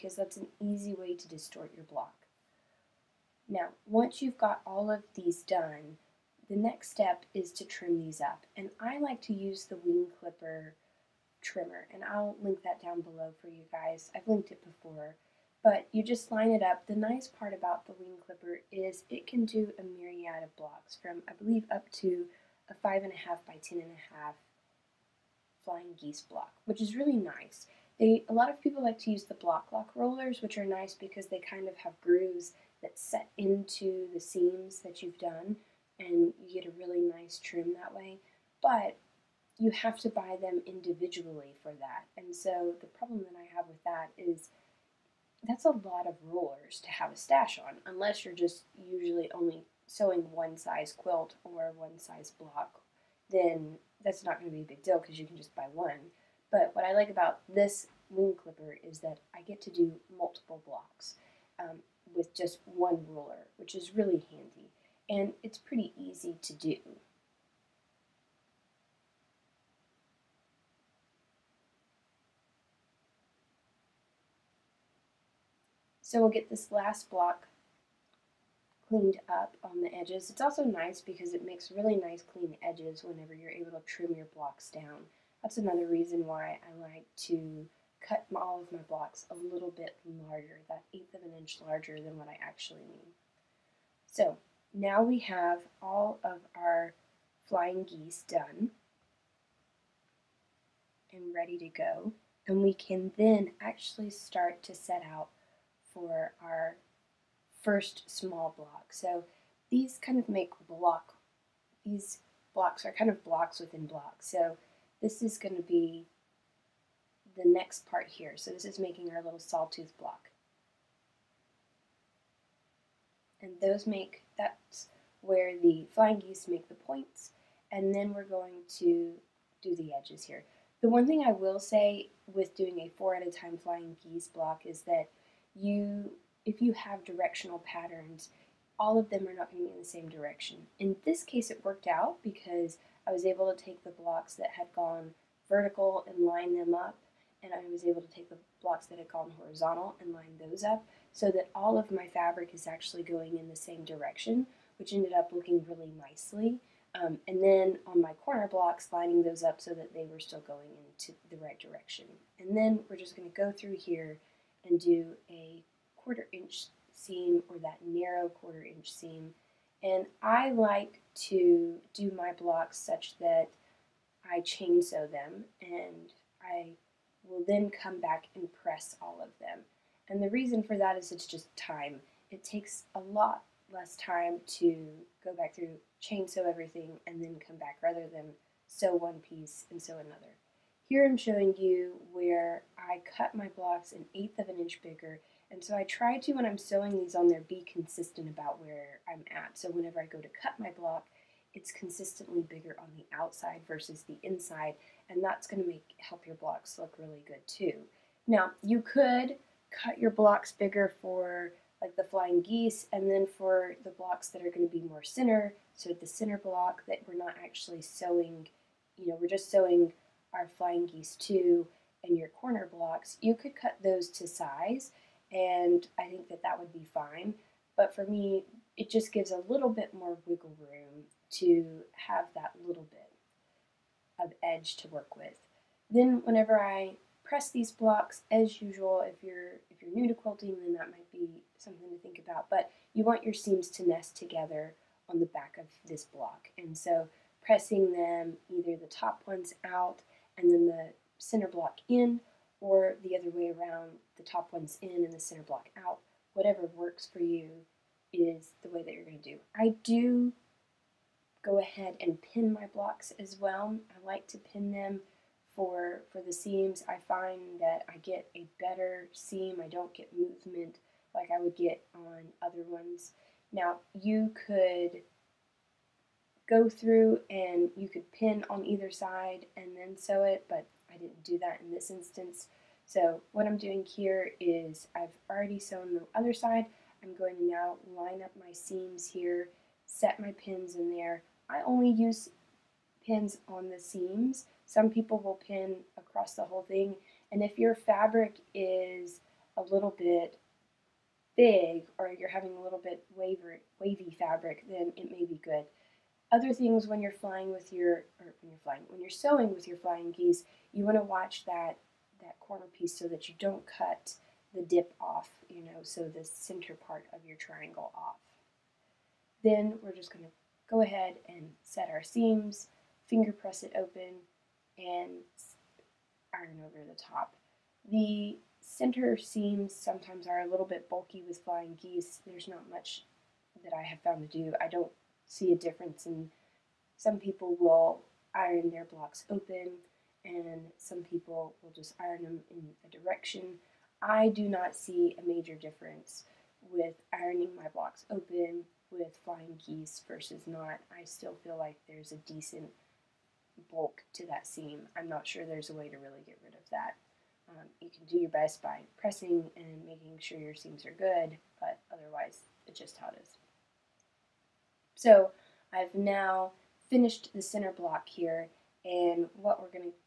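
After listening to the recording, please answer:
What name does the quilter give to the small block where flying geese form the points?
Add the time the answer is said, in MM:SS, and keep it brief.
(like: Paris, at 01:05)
sawtooth block, at 01:59.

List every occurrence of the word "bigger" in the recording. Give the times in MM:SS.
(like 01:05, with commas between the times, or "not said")
03:14, 03:22, 03:30.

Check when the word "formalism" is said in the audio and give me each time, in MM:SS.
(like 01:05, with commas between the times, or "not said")
not said.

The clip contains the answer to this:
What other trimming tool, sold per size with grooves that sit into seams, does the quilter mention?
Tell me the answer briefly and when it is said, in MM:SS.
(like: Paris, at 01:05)
Bloc Loc rollers, at 00:29.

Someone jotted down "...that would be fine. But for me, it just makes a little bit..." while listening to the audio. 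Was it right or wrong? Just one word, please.
wrong.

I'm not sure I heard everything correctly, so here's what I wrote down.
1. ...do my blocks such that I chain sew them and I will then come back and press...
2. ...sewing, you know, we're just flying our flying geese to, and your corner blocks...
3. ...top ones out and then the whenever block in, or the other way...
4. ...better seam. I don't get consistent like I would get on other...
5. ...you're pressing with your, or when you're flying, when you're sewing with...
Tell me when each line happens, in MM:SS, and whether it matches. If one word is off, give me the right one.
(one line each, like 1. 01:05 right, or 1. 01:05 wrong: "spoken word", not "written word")
1. 02:51 right
2. 03:37 wrong: "sewing", not "flying"
3. 04:08 wrong: "center", not "whenever"
4. 04:28 wrong: "movement", not "consistent"
5. 05:07 wrong: "flying", not "pressing".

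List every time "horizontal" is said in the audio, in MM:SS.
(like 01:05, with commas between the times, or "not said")
02:29.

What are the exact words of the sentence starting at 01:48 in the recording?
So these kind of make block, these blocks are kind of blocks within blocks.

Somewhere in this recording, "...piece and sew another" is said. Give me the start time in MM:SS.
03:09.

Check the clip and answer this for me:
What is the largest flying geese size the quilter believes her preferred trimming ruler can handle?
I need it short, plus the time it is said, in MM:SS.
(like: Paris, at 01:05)
5 1/2 by 10 1/2, at 00:22.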